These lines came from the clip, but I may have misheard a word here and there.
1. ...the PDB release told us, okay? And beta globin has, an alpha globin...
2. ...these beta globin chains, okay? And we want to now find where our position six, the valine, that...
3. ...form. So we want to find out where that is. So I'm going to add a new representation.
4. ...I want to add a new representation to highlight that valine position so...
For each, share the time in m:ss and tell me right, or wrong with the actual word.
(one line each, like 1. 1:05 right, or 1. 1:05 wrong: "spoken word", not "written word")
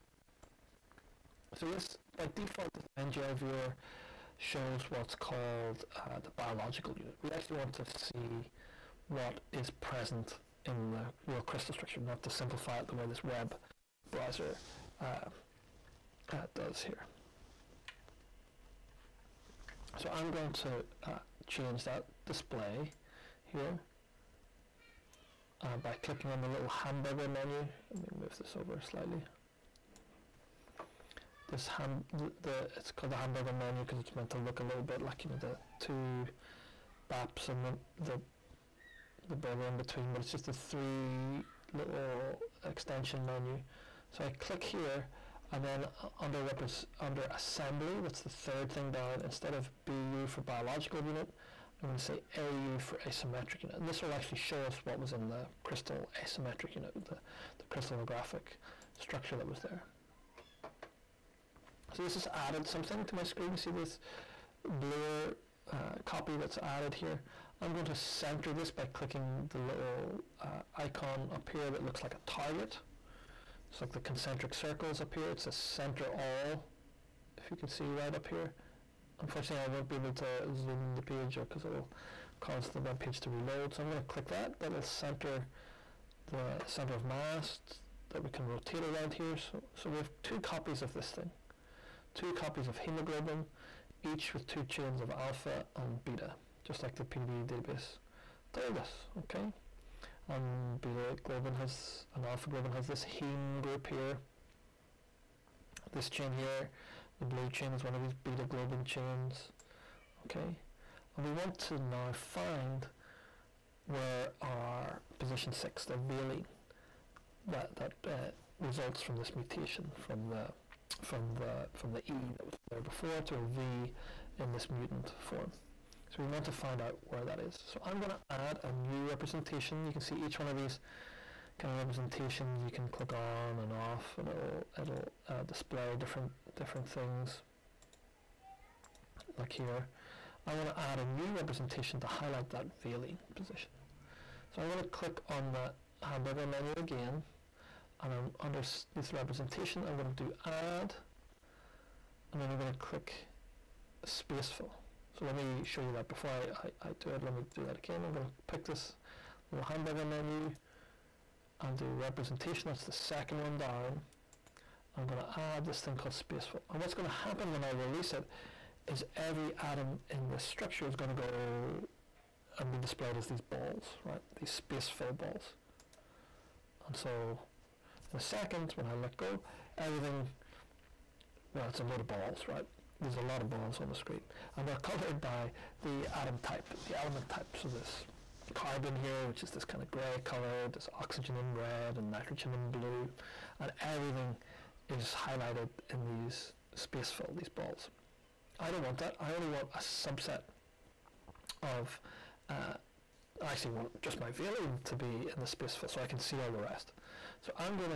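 1. 1:36 wrong: "database", not "release"
2. 1:48 right
3. 2:05 right
4. 2:20 right.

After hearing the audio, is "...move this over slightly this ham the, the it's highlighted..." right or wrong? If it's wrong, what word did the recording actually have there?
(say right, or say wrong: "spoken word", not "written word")
wrong: "called", not "highlighted".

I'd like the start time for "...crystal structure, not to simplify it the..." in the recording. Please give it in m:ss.
0:11.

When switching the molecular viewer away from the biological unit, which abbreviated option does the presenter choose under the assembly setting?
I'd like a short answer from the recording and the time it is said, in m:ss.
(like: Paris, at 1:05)
AU, at 0:52.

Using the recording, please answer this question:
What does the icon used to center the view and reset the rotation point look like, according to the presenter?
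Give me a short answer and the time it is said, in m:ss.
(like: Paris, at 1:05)
A target, at 1:12.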